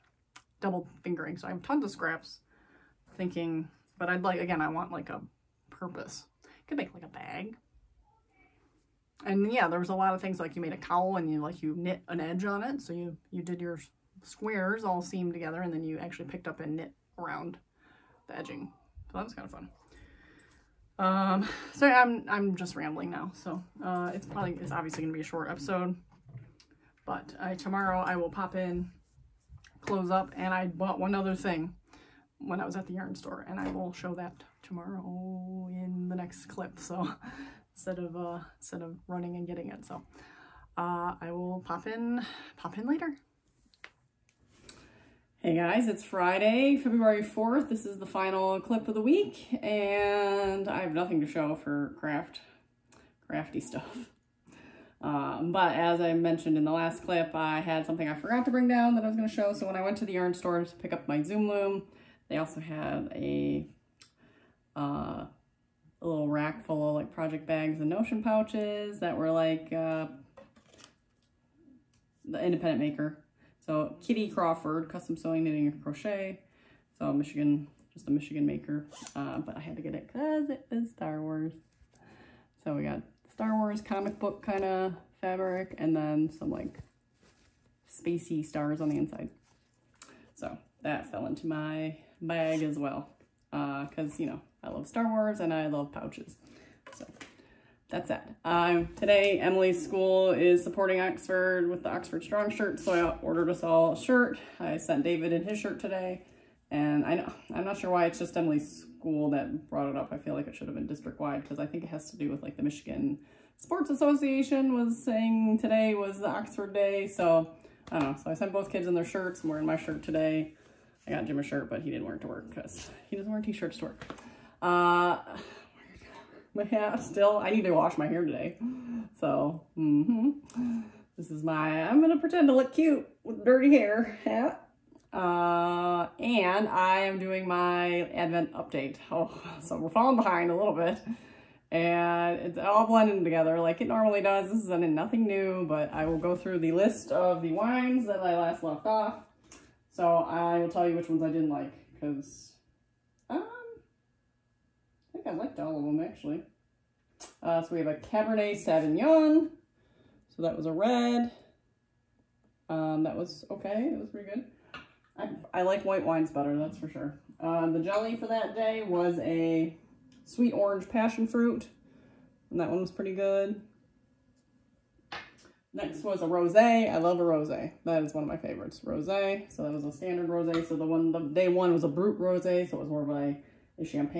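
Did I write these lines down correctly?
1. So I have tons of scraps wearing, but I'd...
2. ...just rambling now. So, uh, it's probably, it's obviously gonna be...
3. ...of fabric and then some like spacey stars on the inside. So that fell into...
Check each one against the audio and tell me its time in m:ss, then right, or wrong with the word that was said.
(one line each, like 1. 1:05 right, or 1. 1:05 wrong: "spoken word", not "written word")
1. 0:01 wrong: "thinking", not "wearing"
2. 0:22 right
3. 1:24 right.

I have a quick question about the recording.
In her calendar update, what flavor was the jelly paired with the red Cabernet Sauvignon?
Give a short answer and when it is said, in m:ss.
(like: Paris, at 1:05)
Sweet orange passion fruit, at 2:50.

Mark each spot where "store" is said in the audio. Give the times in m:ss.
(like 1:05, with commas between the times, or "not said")
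0:33, 1:00.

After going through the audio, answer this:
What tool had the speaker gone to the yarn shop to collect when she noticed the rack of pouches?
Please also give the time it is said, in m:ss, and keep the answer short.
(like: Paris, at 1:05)
Zoom loom, at 1:01.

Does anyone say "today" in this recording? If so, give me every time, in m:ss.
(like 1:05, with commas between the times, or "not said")
1:38, 1:45, 1:55, 2:00, 2:08.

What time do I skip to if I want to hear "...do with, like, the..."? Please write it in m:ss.
1:52.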